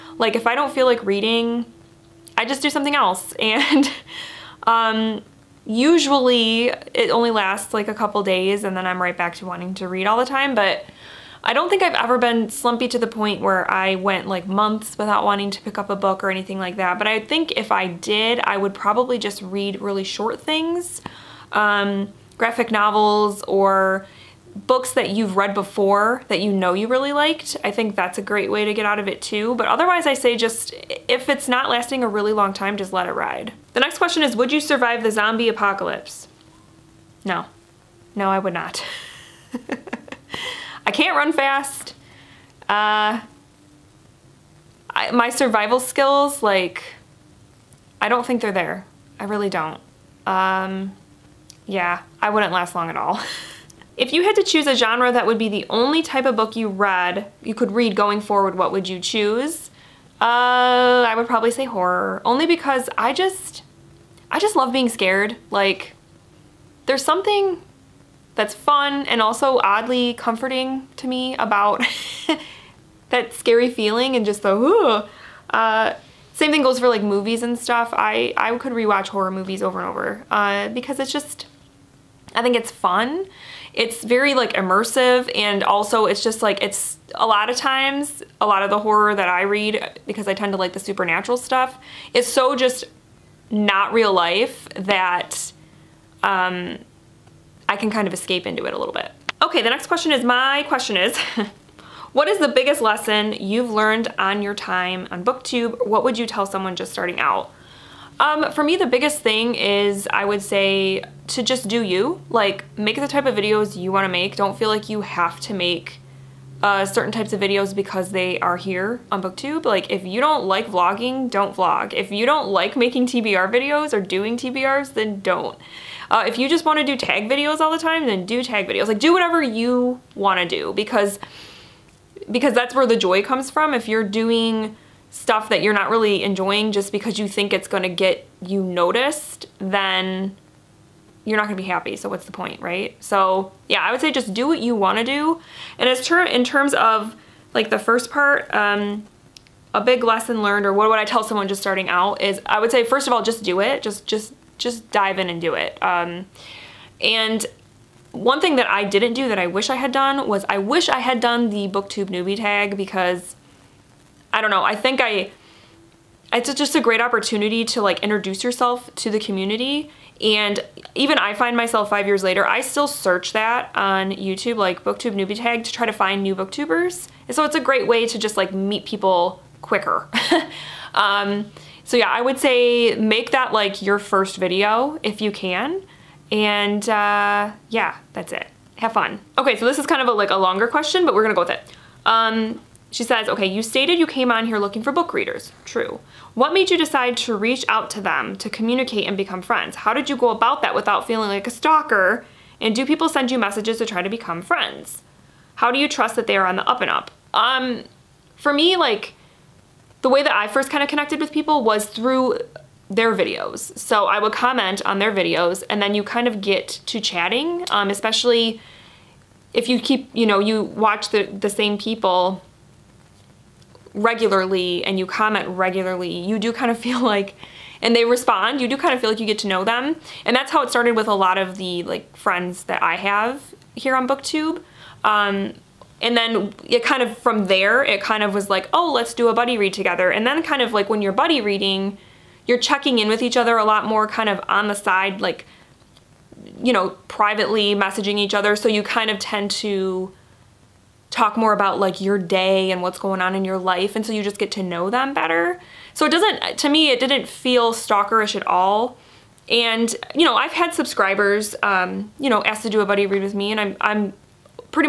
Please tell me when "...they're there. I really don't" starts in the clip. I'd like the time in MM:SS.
00:48.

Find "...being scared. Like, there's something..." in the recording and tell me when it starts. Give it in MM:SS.
01:04.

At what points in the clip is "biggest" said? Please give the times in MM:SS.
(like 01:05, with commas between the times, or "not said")
01:42, 01:48.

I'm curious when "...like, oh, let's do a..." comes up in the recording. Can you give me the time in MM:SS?
03:58.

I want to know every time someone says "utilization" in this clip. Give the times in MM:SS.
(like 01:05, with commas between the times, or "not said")
not said.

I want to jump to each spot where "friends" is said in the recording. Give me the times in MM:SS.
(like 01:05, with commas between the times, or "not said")
03:19, 03:24, 03:52.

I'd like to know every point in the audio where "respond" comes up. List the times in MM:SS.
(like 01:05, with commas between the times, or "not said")
03:48.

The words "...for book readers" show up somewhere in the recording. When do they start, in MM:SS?
03:14.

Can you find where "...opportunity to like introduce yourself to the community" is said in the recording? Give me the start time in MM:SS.
02:47.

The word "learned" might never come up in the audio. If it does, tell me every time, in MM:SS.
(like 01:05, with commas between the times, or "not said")
01:43, 02:30.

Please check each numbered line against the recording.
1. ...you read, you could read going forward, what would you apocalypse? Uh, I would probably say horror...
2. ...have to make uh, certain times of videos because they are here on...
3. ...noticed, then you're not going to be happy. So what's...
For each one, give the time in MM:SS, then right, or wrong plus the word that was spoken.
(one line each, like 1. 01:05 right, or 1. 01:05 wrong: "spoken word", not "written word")
1. 00:56 wrong: "choose", not "apocalypse"
2. 01:55 wrong: "types", not "times"
3. 02:18 right.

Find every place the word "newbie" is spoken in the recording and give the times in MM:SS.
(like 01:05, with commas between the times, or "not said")
02:42, 02:55.